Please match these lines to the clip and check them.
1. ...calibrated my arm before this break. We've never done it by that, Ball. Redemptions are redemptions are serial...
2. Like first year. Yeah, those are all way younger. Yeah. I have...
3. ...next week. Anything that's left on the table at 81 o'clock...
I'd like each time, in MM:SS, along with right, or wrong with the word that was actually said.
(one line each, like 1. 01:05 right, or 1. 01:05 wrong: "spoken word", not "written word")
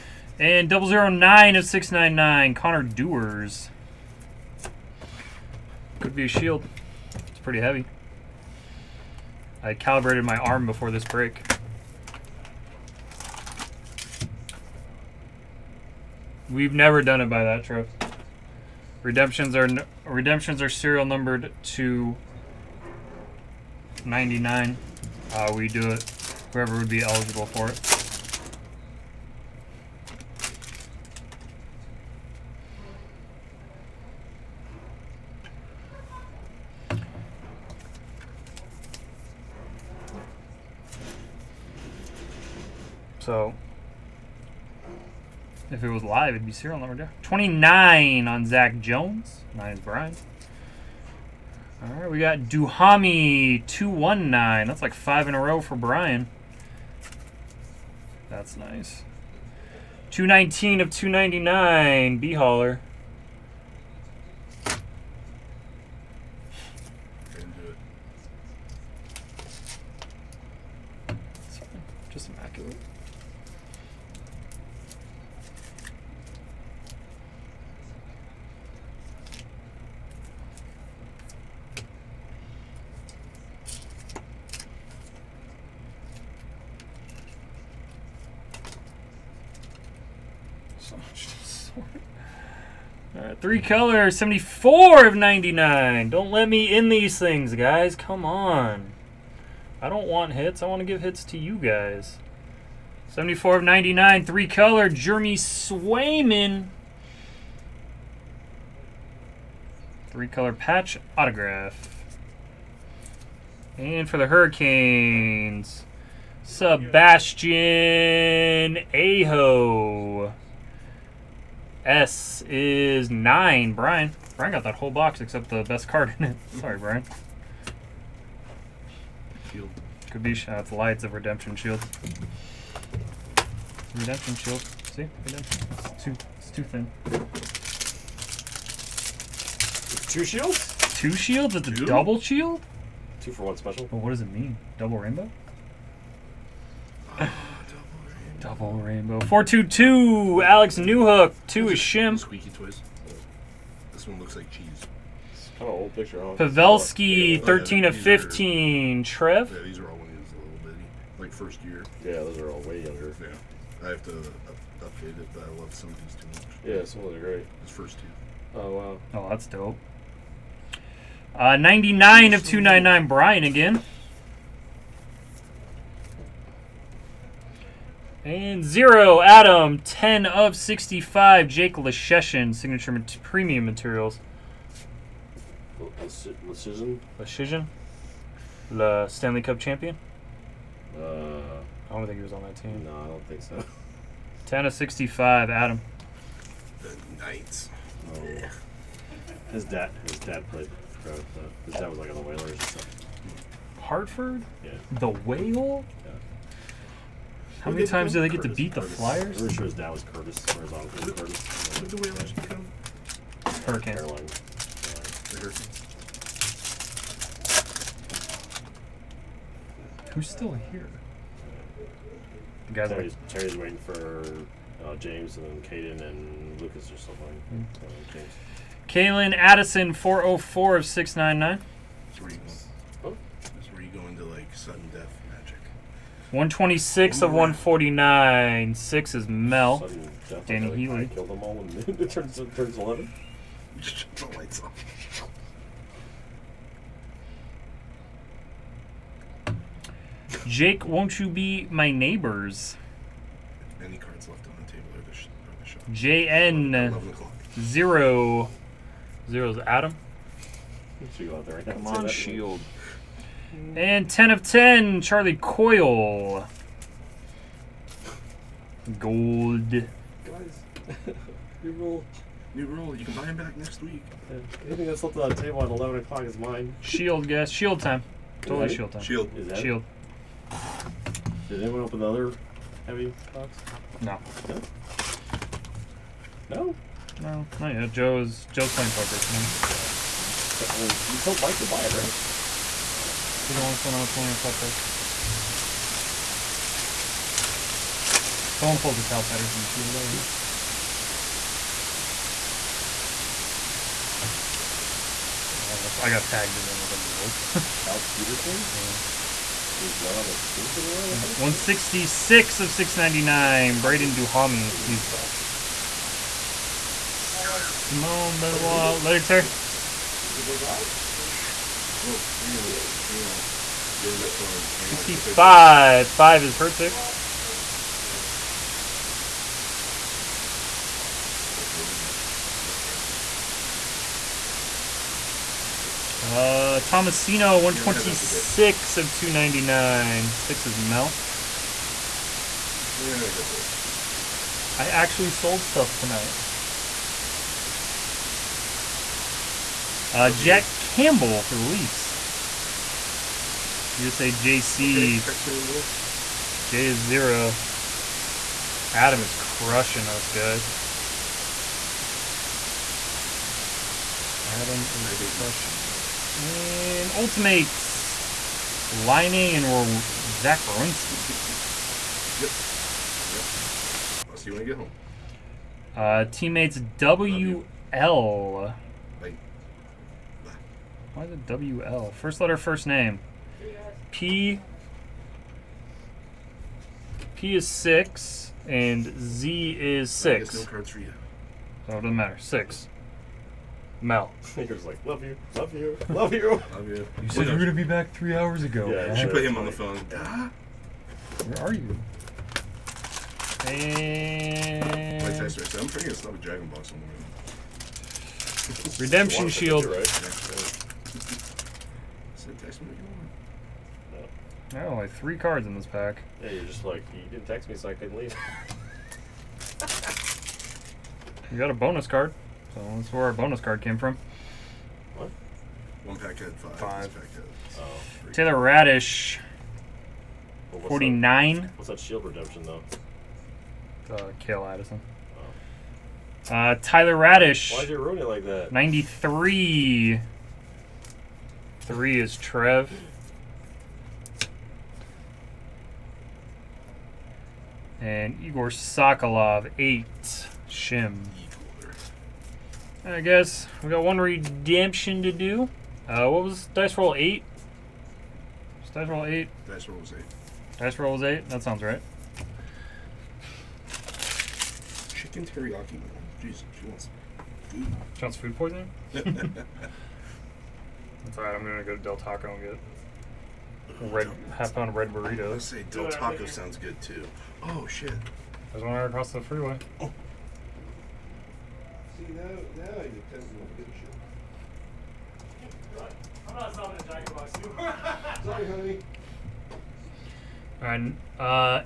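1. 00:09 wrong: "Trev", not "Ball"
2. 02:41 right
3. 04:33 wrong: "11", not "81".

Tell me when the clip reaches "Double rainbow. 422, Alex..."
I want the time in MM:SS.
02:28.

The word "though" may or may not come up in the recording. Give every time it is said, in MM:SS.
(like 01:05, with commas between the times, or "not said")
07:12.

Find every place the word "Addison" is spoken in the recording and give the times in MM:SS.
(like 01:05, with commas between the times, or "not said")
03:49, 07:14.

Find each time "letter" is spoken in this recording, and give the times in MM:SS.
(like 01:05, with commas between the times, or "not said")
05:19, 06:22.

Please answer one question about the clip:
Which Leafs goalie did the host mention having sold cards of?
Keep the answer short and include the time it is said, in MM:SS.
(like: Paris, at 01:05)
Jack Campbell, at 05:50.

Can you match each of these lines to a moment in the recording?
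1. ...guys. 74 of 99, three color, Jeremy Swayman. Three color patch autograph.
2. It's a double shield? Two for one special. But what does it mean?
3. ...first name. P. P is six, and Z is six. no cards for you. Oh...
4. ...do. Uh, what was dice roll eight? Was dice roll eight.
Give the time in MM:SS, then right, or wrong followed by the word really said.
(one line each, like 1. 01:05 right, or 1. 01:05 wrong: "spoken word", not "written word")
1. 01:41 right
2. 02:21 right
3. 06:22 right
4. 07:35 right.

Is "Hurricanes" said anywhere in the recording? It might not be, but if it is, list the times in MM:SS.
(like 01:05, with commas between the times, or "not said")
01:54, 03:33.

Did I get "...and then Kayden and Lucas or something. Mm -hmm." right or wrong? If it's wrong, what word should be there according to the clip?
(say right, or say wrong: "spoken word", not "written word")
right.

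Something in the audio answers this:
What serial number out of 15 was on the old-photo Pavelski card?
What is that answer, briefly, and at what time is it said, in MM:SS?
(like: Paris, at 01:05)
13, at 02:37.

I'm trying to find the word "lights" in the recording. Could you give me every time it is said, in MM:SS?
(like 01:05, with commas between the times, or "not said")
02:10, 04:04.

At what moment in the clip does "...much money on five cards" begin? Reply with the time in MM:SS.
04:53.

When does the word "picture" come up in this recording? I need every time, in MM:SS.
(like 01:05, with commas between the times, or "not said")
02:35.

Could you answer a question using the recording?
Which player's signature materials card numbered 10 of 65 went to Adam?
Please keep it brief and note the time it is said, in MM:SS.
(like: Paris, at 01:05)
Jake Leschyshyn, at 03:01.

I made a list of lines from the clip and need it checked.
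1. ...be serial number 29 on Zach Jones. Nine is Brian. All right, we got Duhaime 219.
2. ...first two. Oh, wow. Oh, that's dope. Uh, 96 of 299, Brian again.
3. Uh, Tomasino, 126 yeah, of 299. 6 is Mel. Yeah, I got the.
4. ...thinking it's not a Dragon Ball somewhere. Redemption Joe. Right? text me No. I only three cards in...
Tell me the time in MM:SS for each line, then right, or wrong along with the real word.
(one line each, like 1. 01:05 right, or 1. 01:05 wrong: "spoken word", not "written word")
1. 00:46 right
2. 02:47 wrong: "99", not "96"
3. 05:36 right
4. 06:45 wrong: "Shield", not "Joe".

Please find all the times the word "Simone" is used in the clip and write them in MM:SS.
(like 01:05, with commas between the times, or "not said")
05:17.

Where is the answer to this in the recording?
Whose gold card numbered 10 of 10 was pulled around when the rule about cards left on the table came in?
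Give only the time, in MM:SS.
04:25.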